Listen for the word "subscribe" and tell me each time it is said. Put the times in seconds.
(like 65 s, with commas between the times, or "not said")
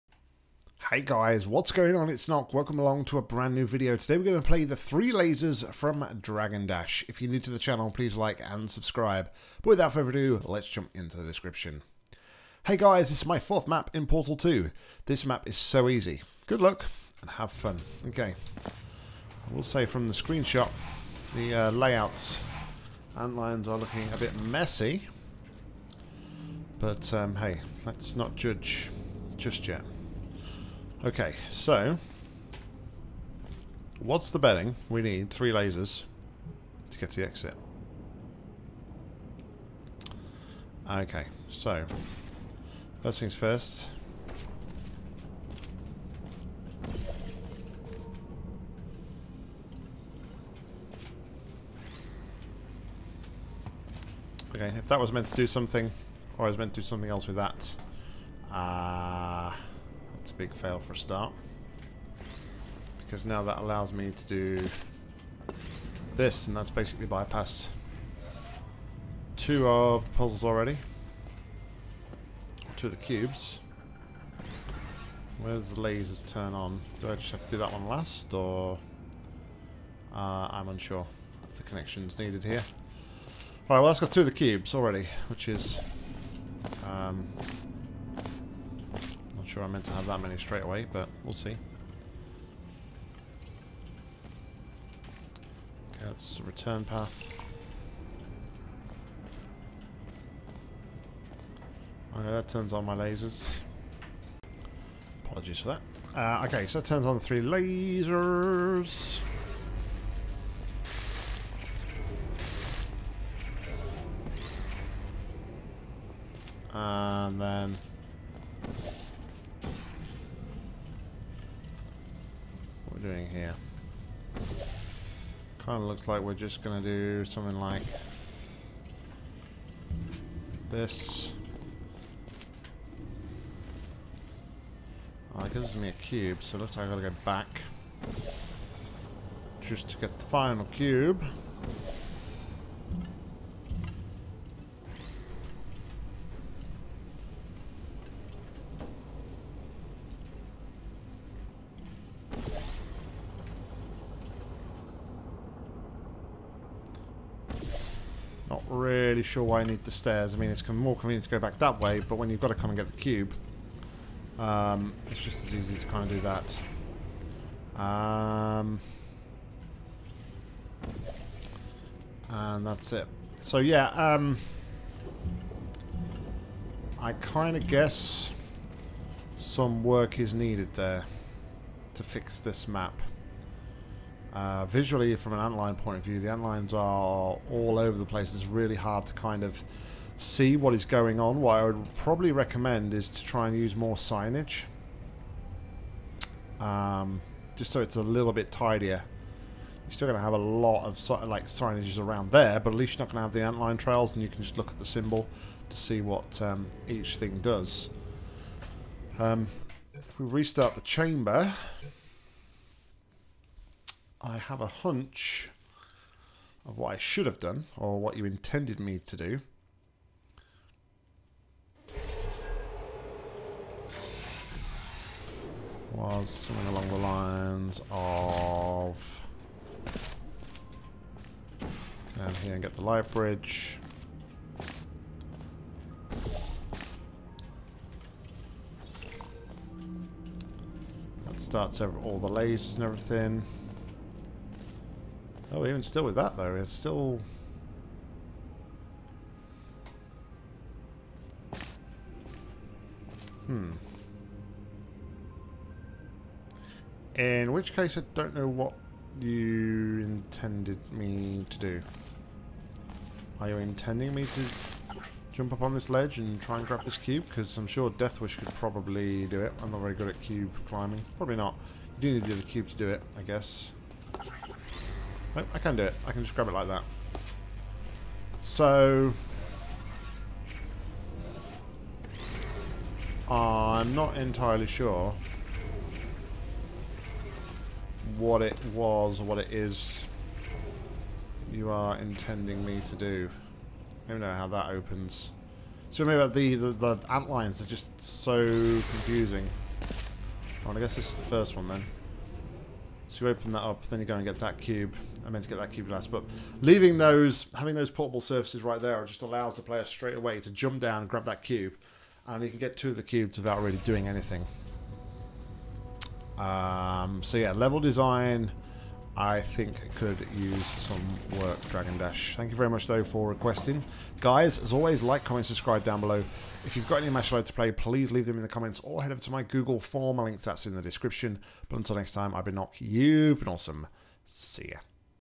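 8 s, 325 s.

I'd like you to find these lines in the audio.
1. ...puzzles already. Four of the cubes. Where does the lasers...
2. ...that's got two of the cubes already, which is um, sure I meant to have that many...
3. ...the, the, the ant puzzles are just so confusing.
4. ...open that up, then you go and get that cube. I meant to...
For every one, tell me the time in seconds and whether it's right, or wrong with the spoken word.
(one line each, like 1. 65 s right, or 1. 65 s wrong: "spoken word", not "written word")
1. 70 s wrong: "Two", not "Four"
2. 83 s right
3. 296 s wrong: "lines", not "puzzles"
4. 303 s right.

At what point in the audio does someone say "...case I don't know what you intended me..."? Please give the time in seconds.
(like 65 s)
257 s.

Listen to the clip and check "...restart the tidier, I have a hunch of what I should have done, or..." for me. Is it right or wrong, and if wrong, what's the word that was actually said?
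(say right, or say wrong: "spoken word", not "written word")
wrong: "chamber", not "tidier".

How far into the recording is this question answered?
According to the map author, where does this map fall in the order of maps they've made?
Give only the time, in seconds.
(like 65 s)
13 s.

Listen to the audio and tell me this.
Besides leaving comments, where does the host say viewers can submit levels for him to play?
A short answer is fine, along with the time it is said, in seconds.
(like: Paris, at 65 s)
Google form, at 329 s.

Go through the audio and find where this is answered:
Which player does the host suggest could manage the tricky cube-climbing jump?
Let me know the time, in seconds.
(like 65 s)
267 s.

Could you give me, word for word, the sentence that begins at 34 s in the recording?
We need three lasers to get to the exit.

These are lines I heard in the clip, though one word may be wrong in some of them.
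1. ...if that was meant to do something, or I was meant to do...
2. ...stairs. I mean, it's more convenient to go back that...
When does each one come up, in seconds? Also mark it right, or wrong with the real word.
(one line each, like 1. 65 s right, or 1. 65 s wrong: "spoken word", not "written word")
1. 54 s right
2. 159 s right.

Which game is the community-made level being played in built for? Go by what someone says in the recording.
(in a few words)
Portal 2.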